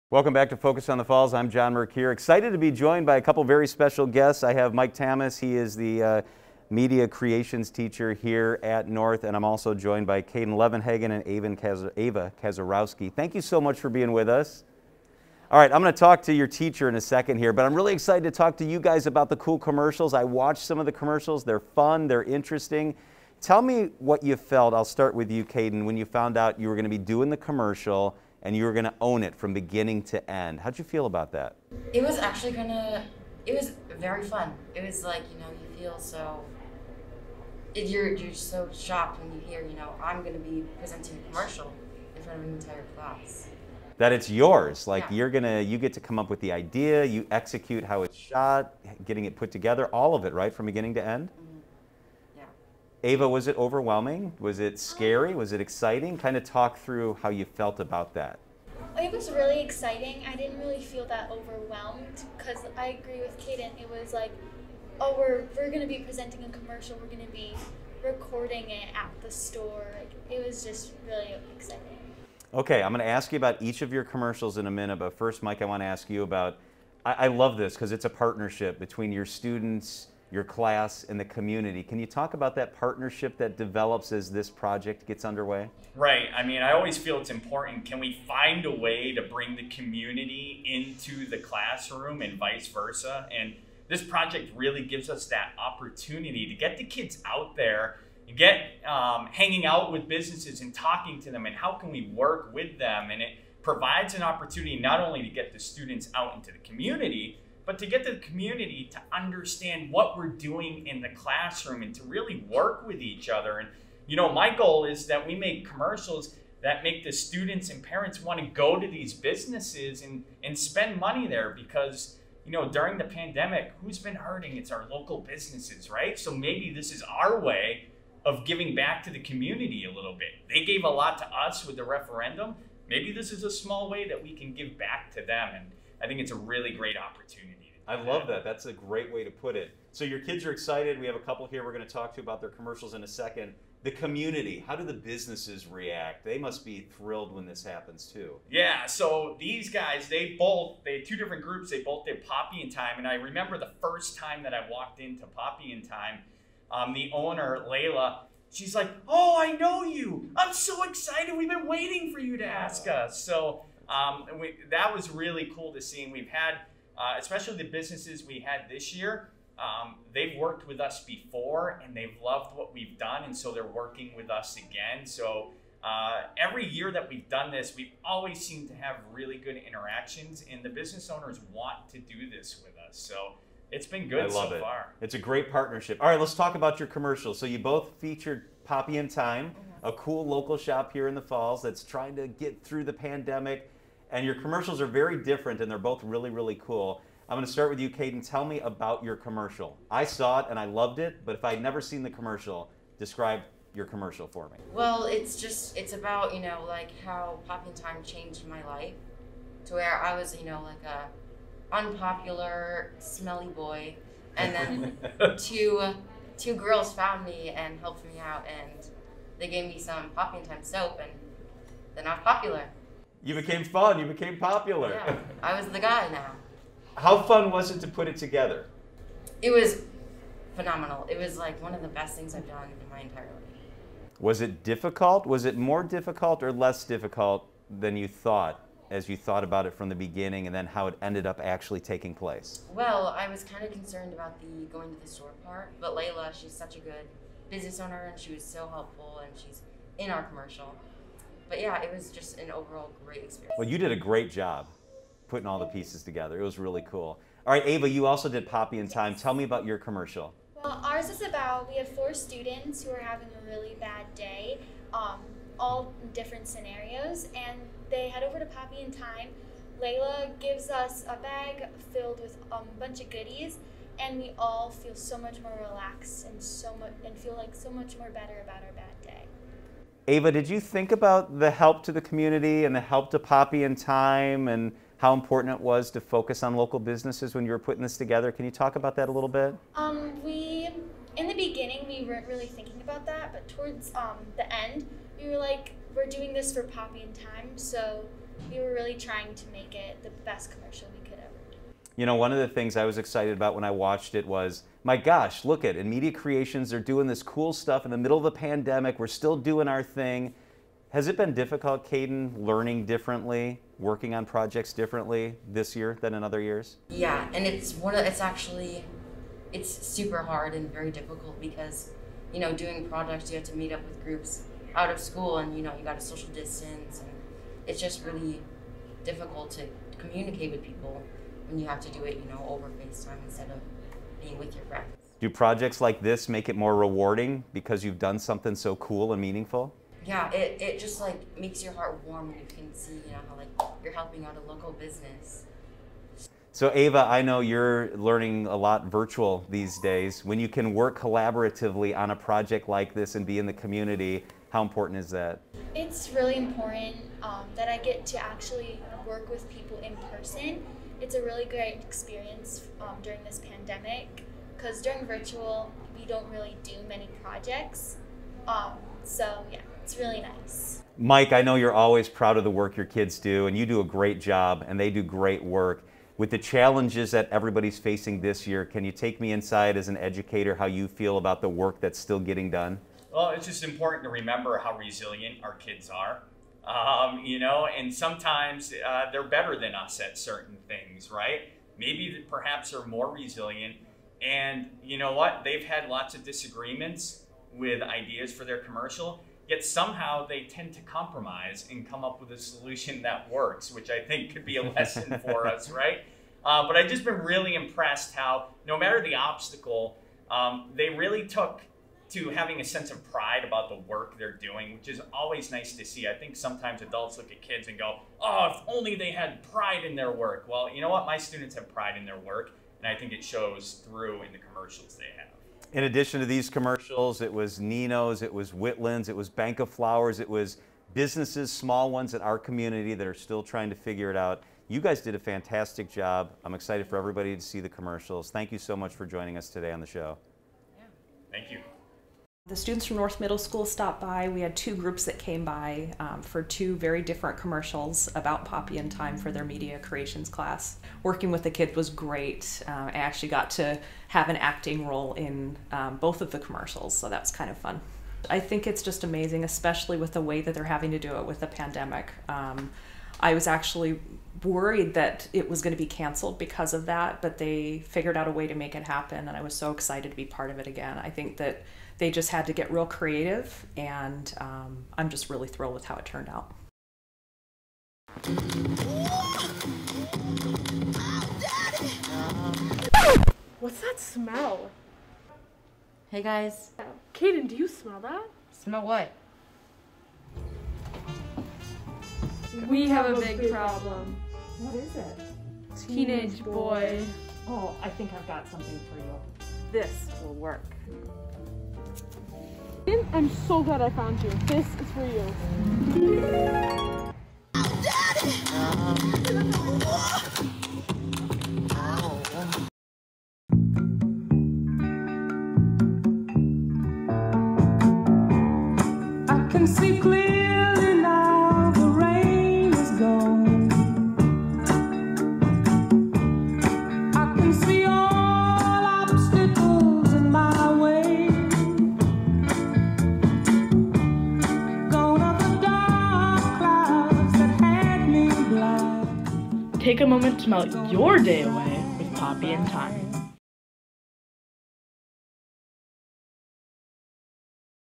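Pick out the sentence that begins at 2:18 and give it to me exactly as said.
That's a great way to put it.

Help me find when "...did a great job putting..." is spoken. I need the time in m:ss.
4:13.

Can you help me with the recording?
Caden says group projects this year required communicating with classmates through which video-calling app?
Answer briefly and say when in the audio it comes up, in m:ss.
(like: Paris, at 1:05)
FaceTime, at 5:32.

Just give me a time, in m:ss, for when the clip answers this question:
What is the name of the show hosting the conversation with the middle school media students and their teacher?
0:00.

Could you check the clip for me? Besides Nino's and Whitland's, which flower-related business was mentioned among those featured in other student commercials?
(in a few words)
Bank of Flowers.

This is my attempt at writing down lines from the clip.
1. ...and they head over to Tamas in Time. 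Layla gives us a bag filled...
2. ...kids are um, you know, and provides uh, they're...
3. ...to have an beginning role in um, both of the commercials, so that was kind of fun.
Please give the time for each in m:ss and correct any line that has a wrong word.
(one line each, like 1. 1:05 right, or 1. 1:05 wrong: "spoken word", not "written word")
1. 4:27 wrong: "Poppy", not "Tamas"
2. 6:25 wrong: "sometimes", not "provides"
3. 7:33 wrong: "acting", not "beginning".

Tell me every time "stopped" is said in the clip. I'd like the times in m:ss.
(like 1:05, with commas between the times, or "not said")
7:23.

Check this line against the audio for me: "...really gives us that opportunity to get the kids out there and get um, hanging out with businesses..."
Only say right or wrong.
right.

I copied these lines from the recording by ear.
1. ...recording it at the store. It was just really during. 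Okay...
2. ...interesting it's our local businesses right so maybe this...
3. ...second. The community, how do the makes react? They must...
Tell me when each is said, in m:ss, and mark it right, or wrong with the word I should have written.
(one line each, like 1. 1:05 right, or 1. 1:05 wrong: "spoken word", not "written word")
1. 1:08 wrong: "exciting", not "during"
2. 2:04 wrong: "hurting", not "interesting"
3. 2:23 wrong: "businesses", not "makes".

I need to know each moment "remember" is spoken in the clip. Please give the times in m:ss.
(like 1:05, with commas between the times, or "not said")
2:33, 6:24.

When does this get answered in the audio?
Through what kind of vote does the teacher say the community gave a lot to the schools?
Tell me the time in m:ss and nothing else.
2:11.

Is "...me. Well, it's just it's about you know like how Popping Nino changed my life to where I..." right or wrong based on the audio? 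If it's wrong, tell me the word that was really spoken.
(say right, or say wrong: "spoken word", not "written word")
wrong: "Time", not "Nino".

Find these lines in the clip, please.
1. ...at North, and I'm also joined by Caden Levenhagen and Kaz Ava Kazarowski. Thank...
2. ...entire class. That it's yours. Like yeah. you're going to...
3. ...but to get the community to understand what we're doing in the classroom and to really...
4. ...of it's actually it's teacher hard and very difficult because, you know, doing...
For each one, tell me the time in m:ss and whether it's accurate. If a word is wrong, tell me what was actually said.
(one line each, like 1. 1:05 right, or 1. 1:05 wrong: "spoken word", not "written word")
1. 0:08 right
2. 0:42 right
3. 1:47 right
4. 5:17 wrong: "super", not "teacher".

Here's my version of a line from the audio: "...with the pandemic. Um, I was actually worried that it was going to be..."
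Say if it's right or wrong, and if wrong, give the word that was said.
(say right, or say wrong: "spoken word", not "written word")
right.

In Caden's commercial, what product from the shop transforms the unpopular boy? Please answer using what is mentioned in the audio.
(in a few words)
Soap.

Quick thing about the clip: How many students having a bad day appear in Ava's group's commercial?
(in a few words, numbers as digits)
4.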